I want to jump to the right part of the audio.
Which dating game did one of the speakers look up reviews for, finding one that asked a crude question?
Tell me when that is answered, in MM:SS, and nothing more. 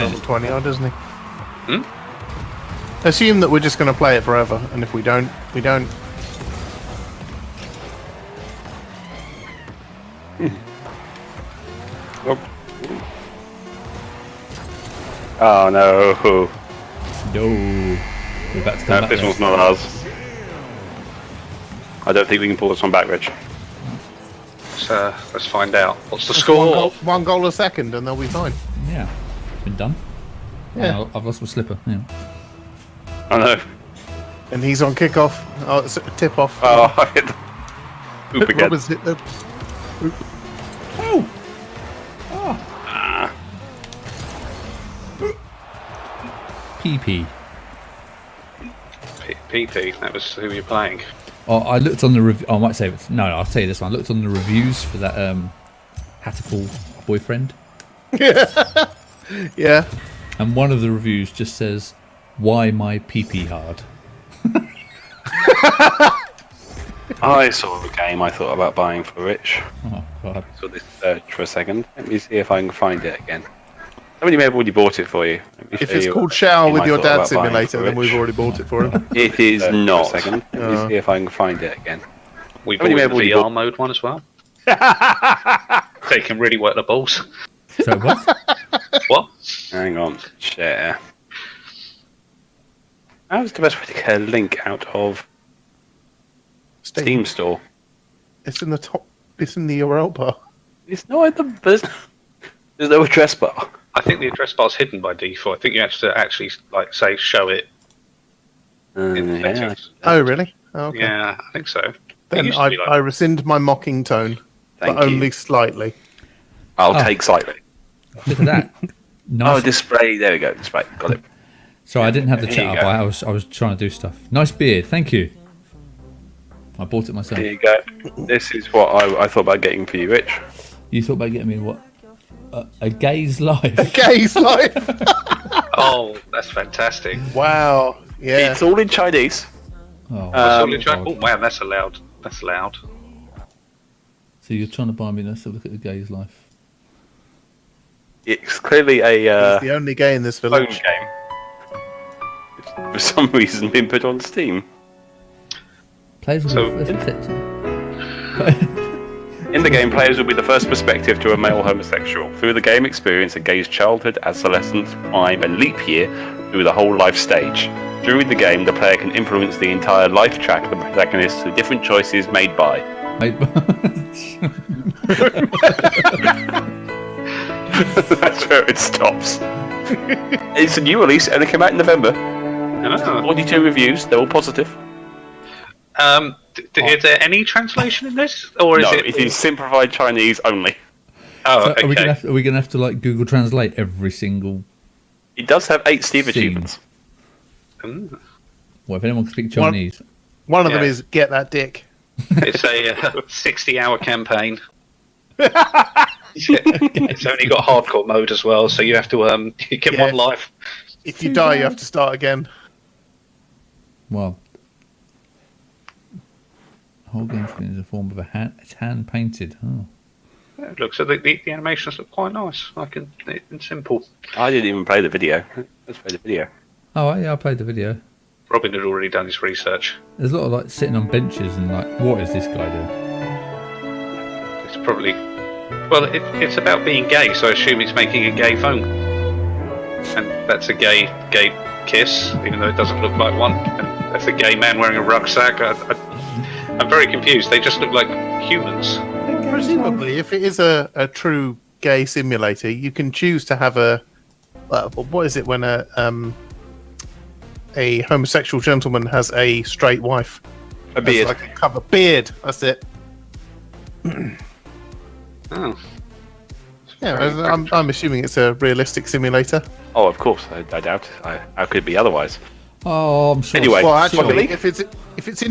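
00:56.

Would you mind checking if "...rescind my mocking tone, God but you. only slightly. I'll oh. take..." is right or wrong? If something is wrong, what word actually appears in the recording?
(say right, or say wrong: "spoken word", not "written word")
wrong: "Thank", not "God".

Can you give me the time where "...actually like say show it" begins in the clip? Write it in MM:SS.
01:46.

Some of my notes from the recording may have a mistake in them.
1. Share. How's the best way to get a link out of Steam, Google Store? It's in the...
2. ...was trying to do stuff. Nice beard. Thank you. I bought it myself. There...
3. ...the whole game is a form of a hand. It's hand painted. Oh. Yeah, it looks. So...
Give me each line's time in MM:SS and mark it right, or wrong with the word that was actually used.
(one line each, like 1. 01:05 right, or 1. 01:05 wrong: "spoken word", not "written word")
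1. 01:30 wrong: "Steam", not "Google"
2. 02:03 right
3. 03:36 right.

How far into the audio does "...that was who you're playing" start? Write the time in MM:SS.
00:50.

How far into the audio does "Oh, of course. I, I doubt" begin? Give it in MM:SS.
04:29.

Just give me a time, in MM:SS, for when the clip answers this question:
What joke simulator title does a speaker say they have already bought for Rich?
01:16.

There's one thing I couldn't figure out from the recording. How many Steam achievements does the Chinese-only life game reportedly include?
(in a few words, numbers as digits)
8.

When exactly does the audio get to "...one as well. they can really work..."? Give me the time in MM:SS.
01:23.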